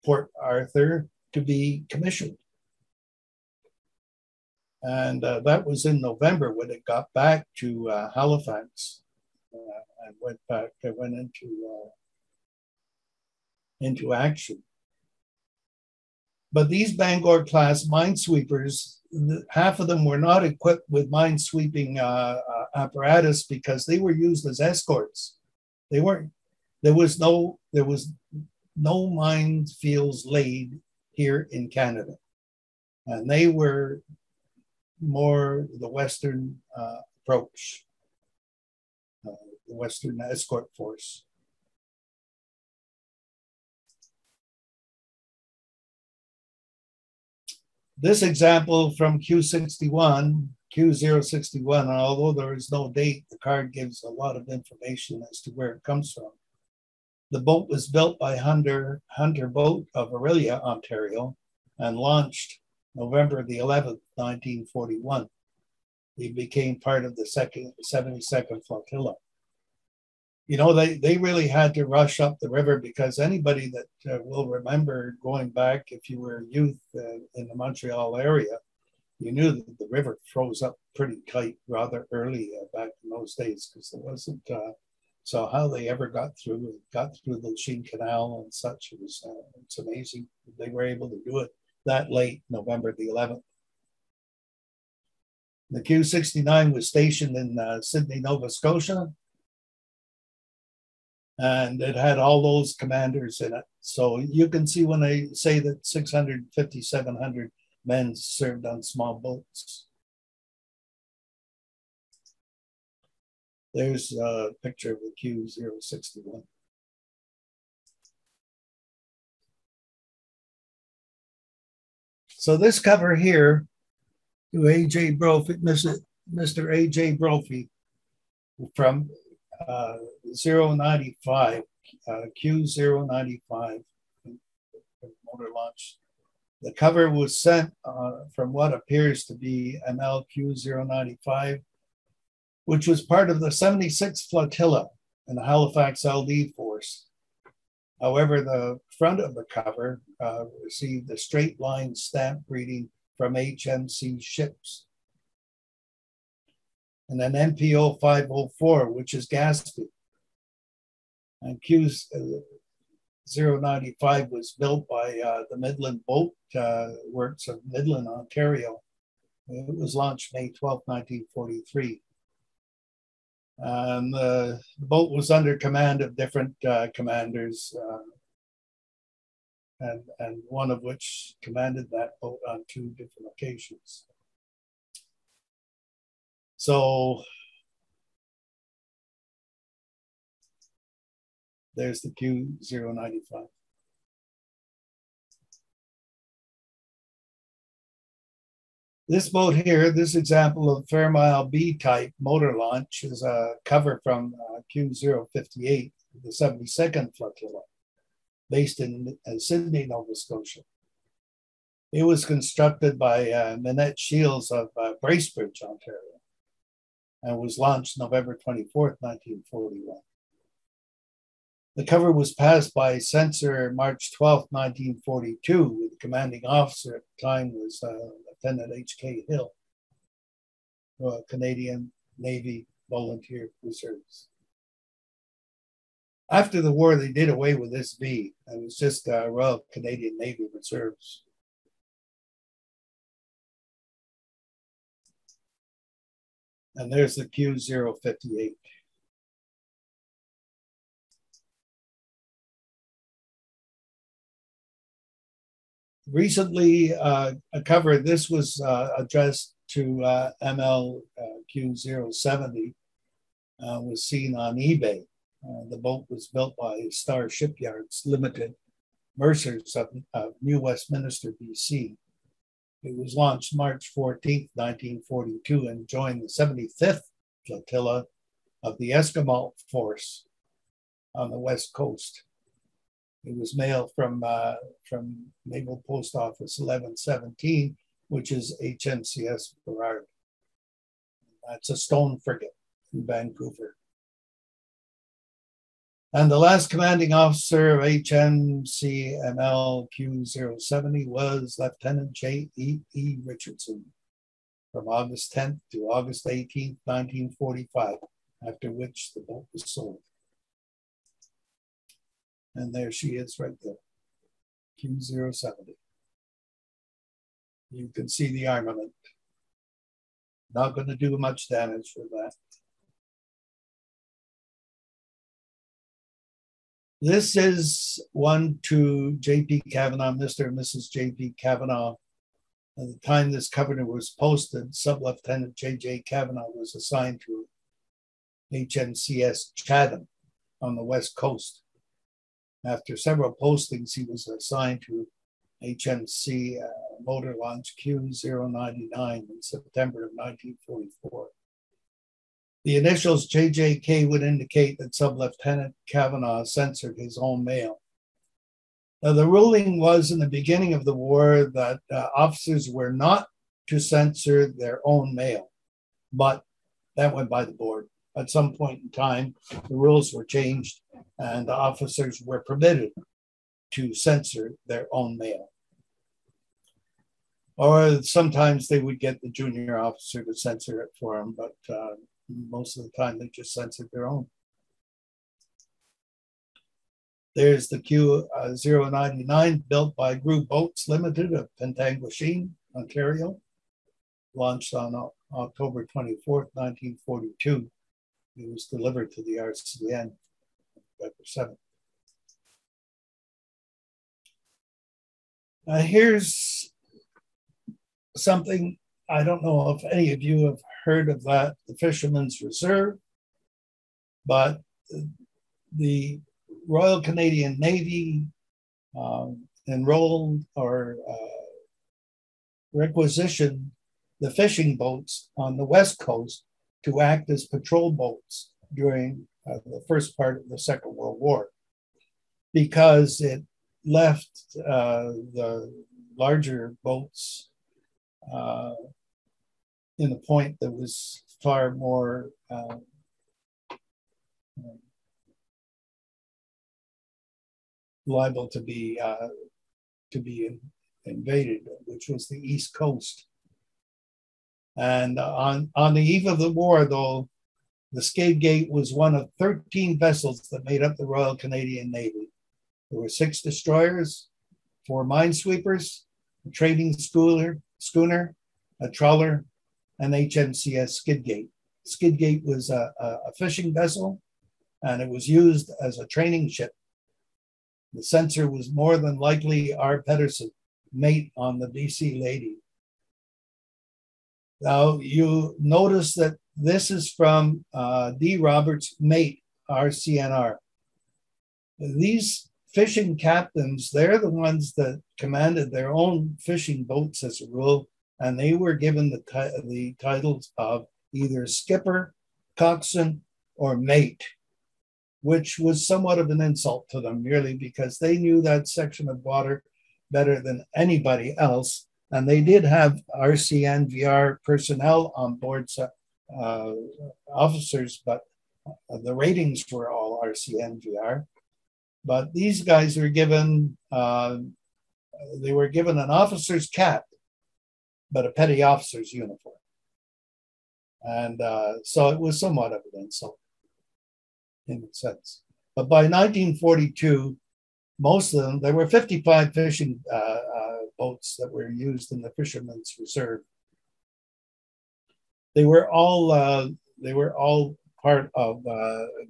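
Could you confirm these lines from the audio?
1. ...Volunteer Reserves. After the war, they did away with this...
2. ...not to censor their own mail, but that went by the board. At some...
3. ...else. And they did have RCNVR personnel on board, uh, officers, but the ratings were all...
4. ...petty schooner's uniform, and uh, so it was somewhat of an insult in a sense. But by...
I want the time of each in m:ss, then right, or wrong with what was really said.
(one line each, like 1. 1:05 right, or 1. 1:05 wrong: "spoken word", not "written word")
1. 3:52 right
2. 6:02 right
3. 8:31 right
4. 8:48 wrong: "officer", not "schooner".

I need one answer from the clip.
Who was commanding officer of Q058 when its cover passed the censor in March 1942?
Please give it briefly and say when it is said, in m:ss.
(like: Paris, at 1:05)
Lieutenant H.K. Hill, at 3:48.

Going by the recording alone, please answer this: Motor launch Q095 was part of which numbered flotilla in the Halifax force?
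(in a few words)
76th.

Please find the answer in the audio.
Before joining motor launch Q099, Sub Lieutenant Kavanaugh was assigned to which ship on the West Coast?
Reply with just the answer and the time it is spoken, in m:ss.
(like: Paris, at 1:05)
HMCS Chatham, at 5:38.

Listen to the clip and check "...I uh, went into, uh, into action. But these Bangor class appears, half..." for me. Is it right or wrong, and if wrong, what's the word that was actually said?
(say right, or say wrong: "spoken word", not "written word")
wrong: "minesweepers", not "appears".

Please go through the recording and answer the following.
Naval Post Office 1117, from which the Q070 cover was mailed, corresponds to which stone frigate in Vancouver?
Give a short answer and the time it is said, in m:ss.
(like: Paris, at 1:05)
HMCS Burrard, at 4:48.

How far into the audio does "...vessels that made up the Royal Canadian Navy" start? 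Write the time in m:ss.
7:39.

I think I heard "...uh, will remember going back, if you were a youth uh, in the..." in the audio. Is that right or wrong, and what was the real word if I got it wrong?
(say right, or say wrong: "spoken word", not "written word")
right.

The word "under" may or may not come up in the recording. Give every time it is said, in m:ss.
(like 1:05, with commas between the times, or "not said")
2:55.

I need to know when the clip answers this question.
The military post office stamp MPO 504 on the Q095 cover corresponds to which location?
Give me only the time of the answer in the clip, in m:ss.
2:39.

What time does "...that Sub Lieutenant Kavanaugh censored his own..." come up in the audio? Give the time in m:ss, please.
5:54.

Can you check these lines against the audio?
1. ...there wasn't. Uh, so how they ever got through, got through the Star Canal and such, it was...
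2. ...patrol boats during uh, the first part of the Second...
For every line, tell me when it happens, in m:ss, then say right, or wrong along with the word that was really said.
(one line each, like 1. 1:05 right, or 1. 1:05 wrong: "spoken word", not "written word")
1. 1:23 wrong: "Lachine", not "Star"
2. 7:07 right.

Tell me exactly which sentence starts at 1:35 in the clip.
The Q 69 was stationed in uh, Sydney, Nova Scotia, and it had all those commanders in it.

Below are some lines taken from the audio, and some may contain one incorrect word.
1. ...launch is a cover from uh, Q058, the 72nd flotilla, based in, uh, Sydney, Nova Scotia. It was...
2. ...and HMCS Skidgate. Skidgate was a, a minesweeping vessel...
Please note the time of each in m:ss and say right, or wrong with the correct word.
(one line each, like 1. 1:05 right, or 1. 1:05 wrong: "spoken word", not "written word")
1. 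3:22 right
2. 7:49 wrong: "fishing", not "minesweeping".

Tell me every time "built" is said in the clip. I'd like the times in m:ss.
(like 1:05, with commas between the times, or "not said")
0:57, 2:44, 4:26, 6:29.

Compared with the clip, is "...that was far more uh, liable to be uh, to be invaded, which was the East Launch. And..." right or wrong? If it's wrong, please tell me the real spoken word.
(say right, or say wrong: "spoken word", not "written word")
wrong: "Coast", not "Launch".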